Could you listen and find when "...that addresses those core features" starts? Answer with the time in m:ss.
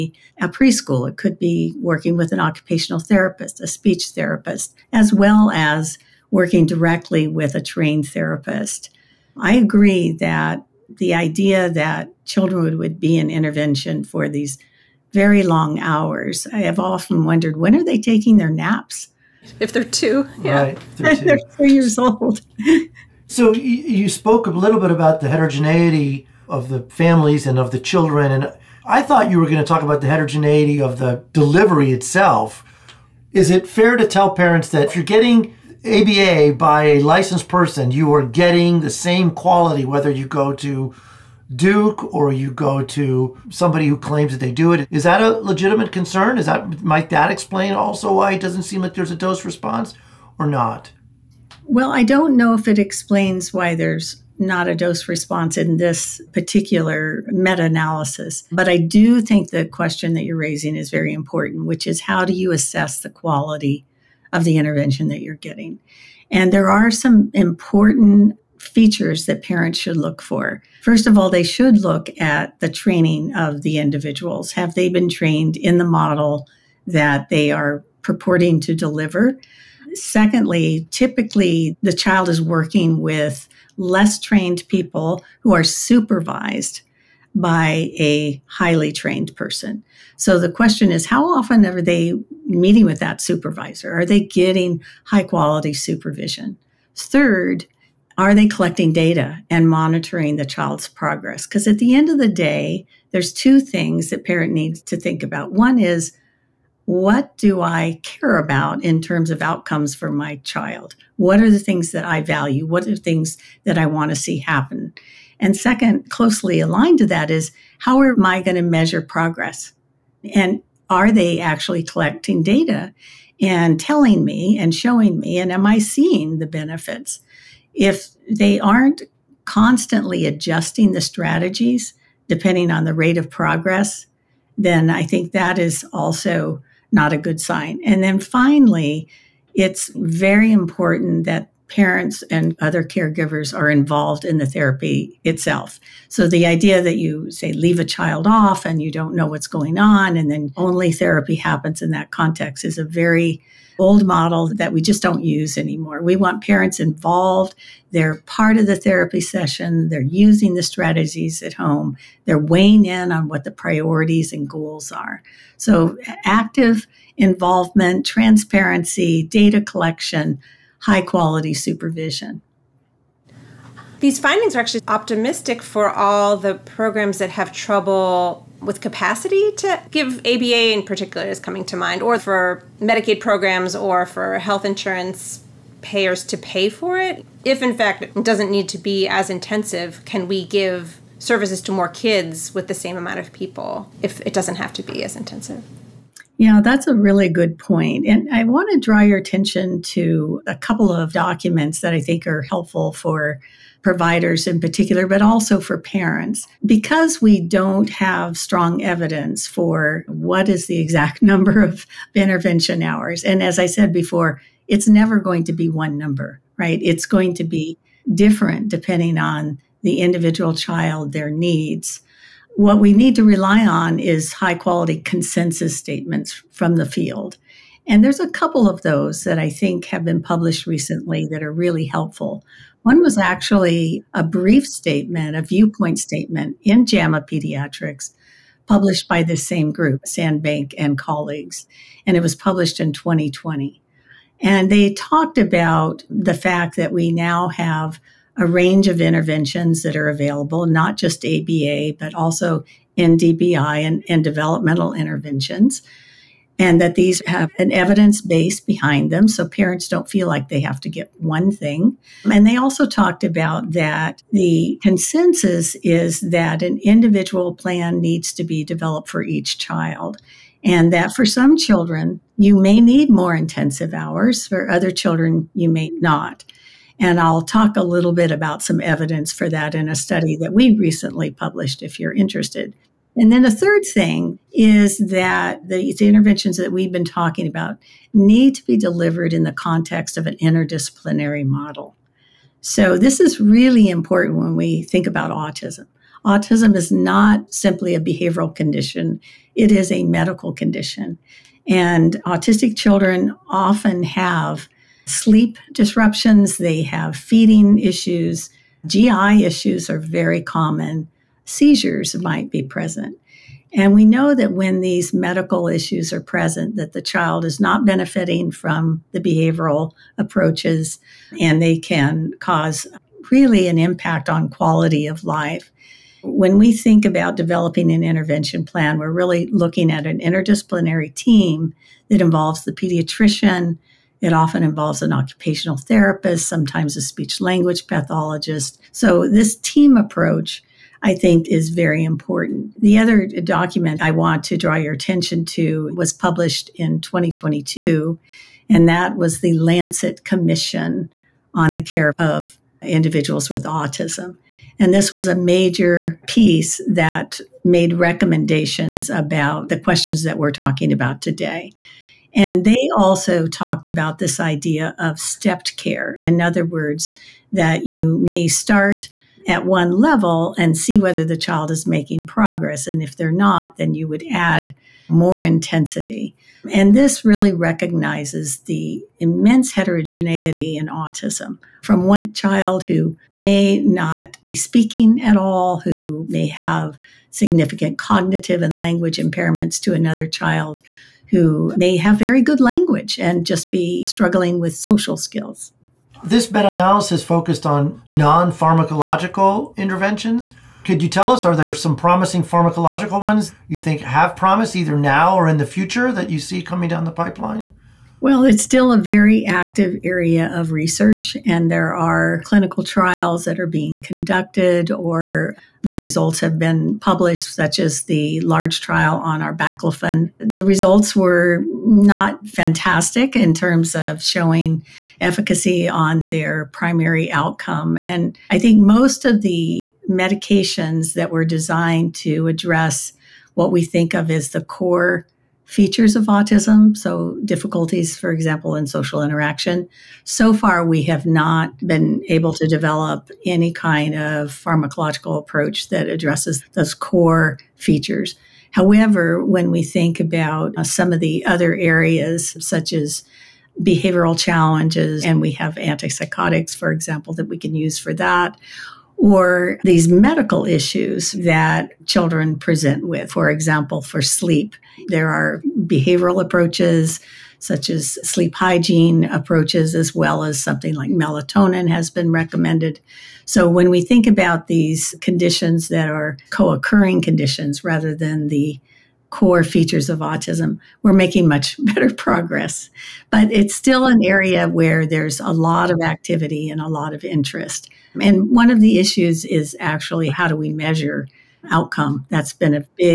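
7:25.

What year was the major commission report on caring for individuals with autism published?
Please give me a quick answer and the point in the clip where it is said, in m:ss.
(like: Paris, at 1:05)
2022, at 5:47.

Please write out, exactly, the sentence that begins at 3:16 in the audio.
Yeah, that's a really good point.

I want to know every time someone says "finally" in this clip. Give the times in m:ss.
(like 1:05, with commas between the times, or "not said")
2:18.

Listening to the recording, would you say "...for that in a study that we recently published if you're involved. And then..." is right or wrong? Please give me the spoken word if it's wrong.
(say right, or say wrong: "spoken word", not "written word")
wrong: "interested", not "involved".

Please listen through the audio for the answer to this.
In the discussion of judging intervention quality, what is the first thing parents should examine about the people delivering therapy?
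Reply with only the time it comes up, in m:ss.
1:12.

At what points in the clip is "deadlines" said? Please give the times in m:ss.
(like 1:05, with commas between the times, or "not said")
not said.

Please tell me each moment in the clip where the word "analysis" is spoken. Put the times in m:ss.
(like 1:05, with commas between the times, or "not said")
0:57, 6:36.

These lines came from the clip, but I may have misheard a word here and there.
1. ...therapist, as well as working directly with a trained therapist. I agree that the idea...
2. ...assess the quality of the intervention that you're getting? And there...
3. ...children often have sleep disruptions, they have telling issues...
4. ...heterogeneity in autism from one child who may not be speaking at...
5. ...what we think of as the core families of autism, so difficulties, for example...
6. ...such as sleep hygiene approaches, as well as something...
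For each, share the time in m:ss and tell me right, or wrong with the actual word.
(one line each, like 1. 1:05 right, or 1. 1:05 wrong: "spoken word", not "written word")
1. 0:04 right
2. 1:02 right
3. 5:02 wrong: "feeding", not "telling"
4. 6:19 right
5. 7:13 wrong: "features", not "families"
6. 7:47 right.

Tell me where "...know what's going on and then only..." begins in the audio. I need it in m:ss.
2:29.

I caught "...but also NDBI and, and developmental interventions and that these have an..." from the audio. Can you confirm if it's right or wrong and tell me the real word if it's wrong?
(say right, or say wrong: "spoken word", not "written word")
right.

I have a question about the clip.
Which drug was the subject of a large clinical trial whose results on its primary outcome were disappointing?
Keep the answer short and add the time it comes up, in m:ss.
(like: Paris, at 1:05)
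Arbaclofen, at 6:59.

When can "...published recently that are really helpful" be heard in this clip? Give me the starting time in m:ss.
3:50.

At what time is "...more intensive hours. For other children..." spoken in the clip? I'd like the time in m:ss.
4:33.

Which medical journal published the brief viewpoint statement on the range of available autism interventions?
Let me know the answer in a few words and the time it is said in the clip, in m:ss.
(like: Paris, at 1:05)
JAMA Pediatrics, at 3:56.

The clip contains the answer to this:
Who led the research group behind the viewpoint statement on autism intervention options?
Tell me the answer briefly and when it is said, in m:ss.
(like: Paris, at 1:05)
Sandbank, at 4:00.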